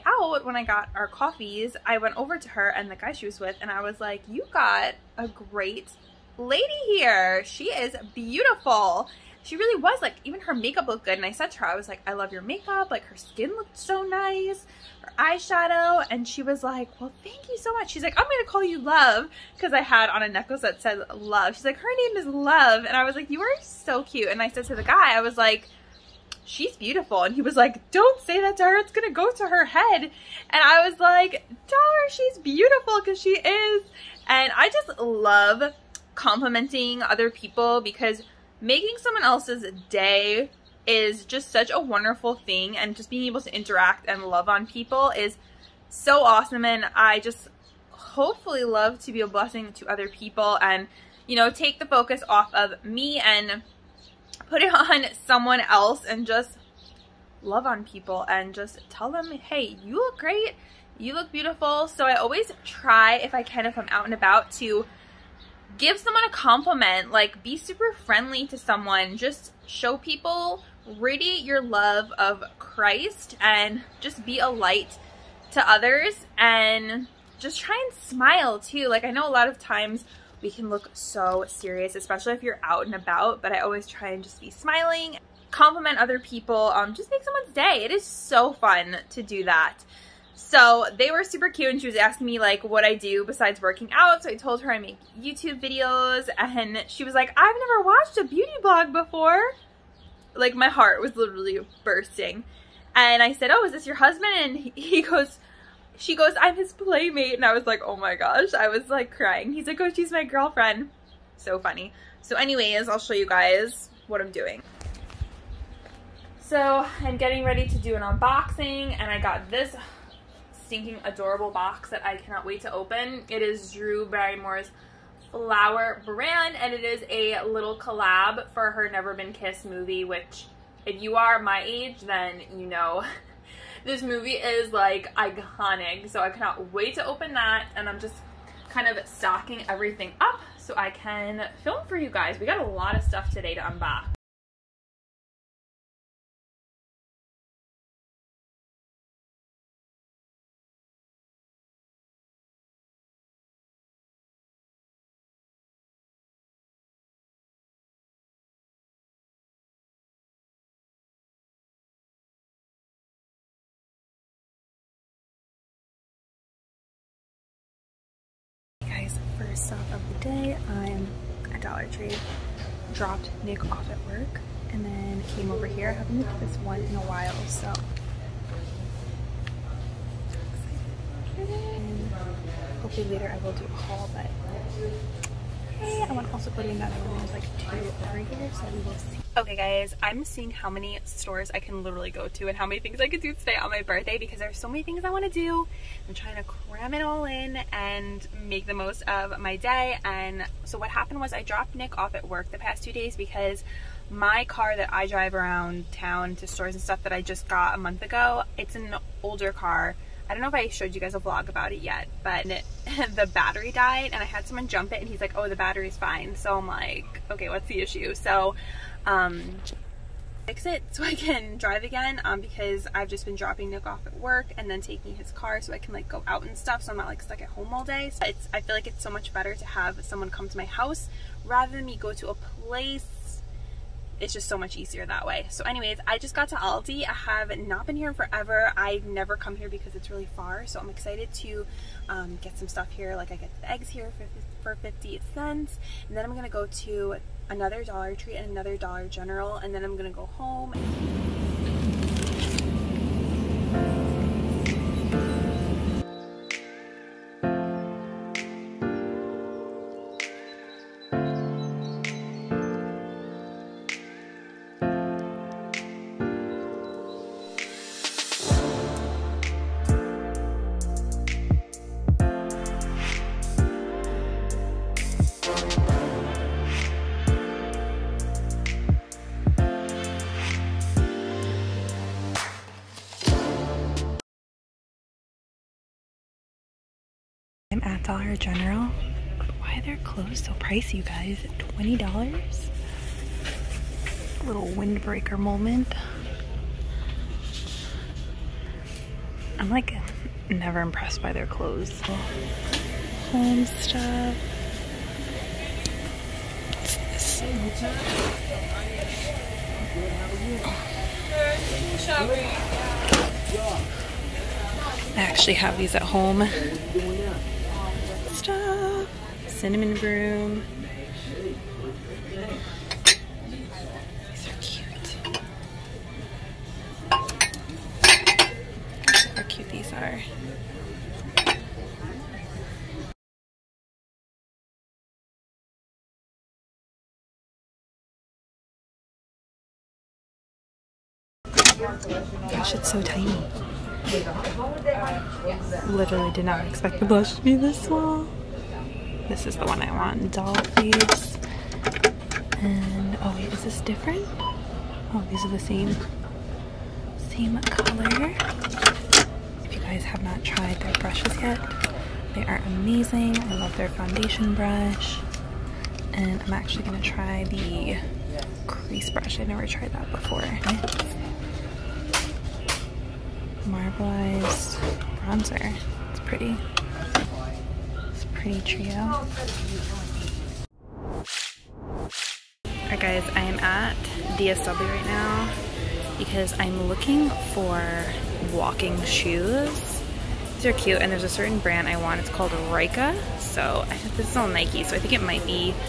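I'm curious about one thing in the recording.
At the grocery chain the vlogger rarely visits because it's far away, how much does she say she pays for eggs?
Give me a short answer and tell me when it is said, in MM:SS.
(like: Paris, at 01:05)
50 cents, at 04:04.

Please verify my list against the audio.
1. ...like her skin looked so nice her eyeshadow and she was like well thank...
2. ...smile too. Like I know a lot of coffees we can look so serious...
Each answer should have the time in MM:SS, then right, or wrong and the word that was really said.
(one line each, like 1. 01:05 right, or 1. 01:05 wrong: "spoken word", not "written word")
1. 00:12 right
2. 01:17 wrong: "times", not "coffees".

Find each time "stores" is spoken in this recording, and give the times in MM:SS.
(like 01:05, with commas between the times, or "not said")
03:11, 03:26.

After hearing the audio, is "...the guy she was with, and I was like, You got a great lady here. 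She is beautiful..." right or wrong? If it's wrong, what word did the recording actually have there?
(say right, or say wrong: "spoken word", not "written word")
right.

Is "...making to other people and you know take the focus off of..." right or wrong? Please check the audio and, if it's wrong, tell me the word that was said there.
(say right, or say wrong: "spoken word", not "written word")
wrong: "blessing", not "making".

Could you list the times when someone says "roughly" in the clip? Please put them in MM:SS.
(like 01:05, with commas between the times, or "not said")
not said.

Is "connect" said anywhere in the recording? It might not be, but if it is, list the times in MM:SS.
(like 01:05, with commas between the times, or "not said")
not said.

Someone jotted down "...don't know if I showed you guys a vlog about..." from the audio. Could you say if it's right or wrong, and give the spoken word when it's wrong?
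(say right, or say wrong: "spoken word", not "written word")
right.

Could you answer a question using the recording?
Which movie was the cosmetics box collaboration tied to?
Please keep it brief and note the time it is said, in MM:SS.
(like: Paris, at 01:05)
Never Been Kissed, at 02:08.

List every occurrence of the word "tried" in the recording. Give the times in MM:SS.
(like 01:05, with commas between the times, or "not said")
06:00, 06:09.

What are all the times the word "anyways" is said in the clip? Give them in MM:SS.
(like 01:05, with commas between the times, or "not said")
01:52, 03:55.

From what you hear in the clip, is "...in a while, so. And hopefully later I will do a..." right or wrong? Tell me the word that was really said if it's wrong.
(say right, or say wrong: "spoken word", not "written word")
right.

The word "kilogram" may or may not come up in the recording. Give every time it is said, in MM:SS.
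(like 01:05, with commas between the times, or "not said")
not said.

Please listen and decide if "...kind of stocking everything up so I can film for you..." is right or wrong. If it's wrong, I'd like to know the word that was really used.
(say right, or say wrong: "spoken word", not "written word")
right.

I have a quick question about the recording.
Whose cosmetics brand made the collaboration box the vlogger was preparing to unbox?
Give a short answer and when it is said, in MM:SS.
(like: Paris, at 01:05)
Drew Barrymore, at 02:03.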